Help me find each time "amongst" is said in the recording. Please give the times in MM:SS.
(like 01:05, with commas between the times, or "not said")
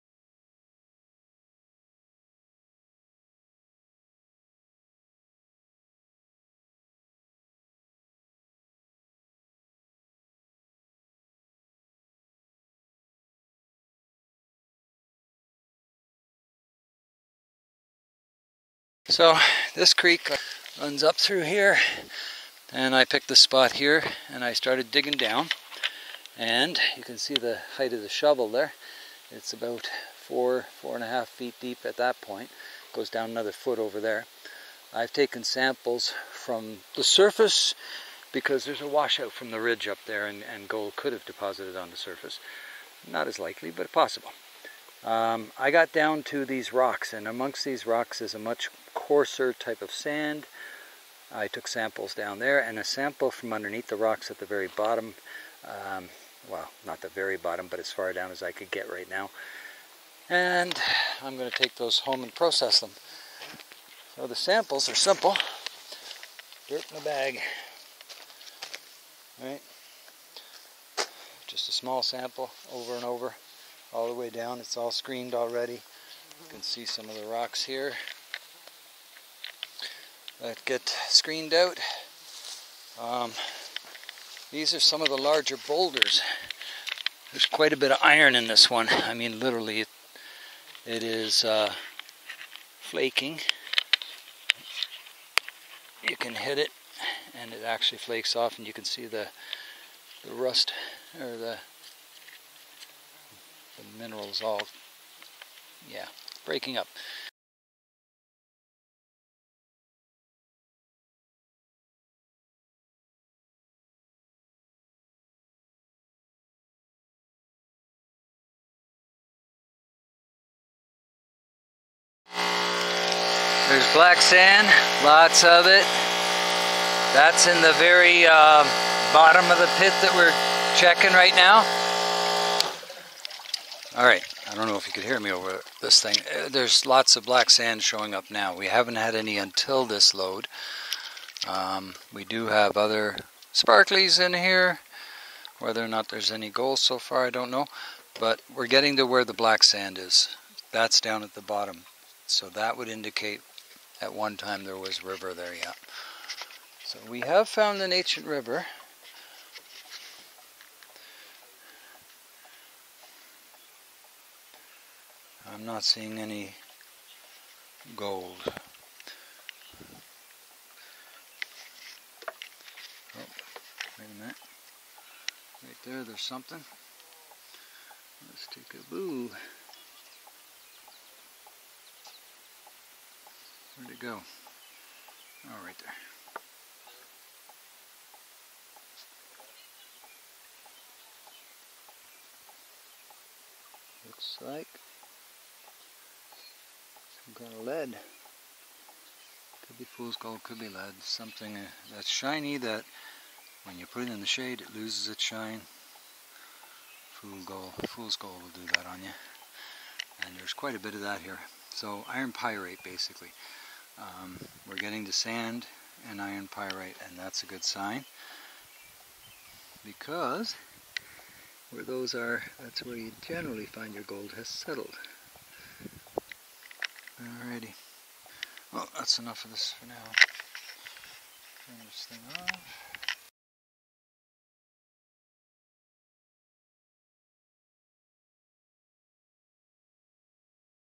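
00:47.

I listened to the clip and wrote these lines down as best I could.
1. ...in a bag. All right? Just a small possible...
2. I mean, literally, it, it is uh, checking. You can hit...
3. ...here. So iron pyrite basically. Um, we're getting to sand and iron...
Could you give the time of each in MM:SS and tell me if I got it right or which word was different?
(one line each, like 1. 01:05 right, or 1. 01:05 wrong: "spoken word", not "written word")
1. 01:06 wrong: "sample", not "possible"
2. 01:28 wrong: "flaking", not "checking"
3. 03:31 right.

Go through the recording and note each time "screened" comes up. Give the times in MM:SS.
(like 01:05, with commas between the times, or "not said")
01:14, 01:21.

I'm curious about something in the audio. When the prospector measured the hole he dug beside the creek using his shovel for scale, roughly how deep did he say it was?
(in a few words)
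4 and a half feet.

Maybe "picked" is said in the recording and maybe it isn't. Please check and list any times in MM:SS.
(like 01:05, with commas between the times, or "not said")
00:23.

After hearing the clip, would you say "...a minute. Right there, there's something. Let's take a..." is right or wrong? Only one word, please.
right.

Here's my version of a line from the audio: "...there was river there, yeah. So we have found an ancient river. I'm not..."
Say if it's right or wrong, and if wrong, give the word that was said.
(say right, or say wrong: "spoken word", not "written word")
right.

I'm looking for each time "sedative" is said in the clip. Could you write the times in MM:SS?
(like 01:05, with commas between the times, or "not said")
not said.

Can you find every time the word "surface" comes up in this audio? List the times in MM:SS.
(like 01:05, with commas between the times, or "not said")
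00:37, 00:41.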